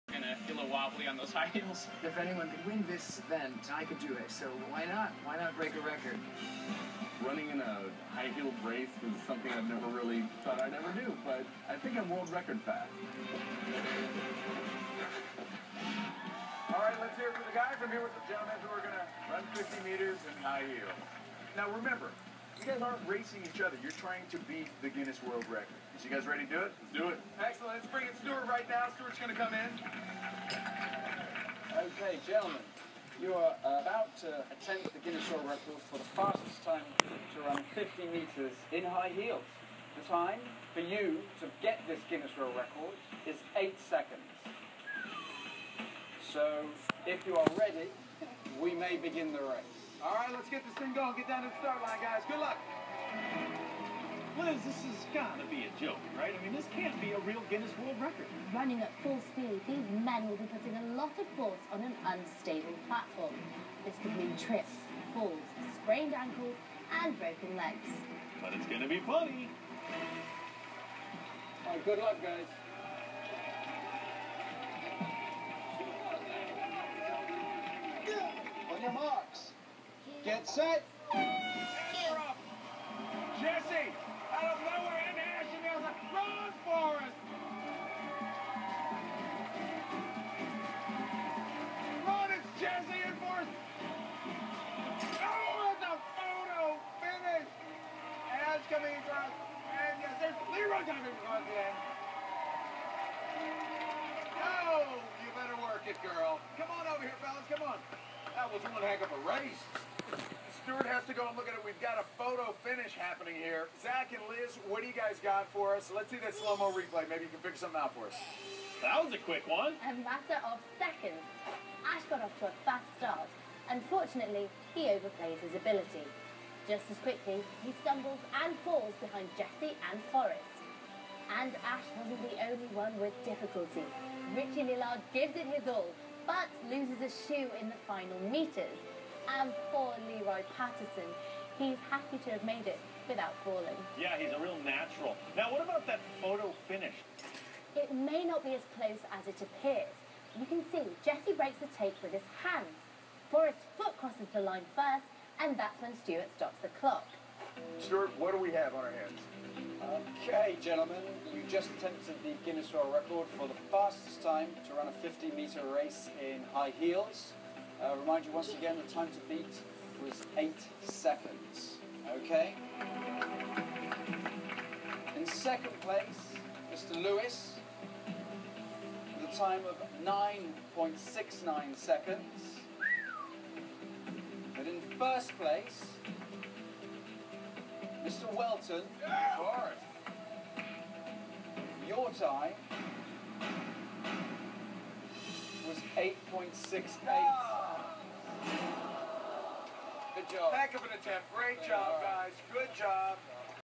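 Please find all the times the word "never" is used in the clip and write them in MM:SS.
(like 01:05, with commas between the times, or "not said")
00:09.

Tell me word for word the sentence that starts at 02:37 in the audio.
Stuart, what do we have on our hands?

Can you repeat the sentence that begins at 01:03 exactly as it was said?
This could mean trips, falls, sprained ankles, and broken legs.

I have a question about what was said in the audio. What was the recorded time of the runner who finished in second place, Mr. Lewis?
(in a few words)
9.69 seconds.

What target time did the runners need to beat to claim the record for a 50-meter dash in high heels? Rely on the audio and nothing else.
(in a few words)
8 seconds.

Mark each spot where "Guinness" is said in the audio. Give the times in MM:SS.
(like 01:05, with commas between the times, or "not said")
00:24, 00:35, 00:42, 00:57, 02:42.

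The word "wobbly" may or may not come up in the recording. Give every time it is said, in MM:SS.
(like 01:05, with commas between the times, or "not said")
00:00.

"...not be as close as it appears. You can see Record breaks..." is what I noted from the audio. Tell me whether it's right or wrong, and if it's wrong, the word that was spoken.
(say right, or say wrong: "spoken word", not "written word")
wrong: "Jesse", not "Record".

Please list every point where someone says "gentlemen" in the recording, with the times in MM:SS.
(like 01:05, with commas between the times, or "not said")
00:18, 00:32, 02:40.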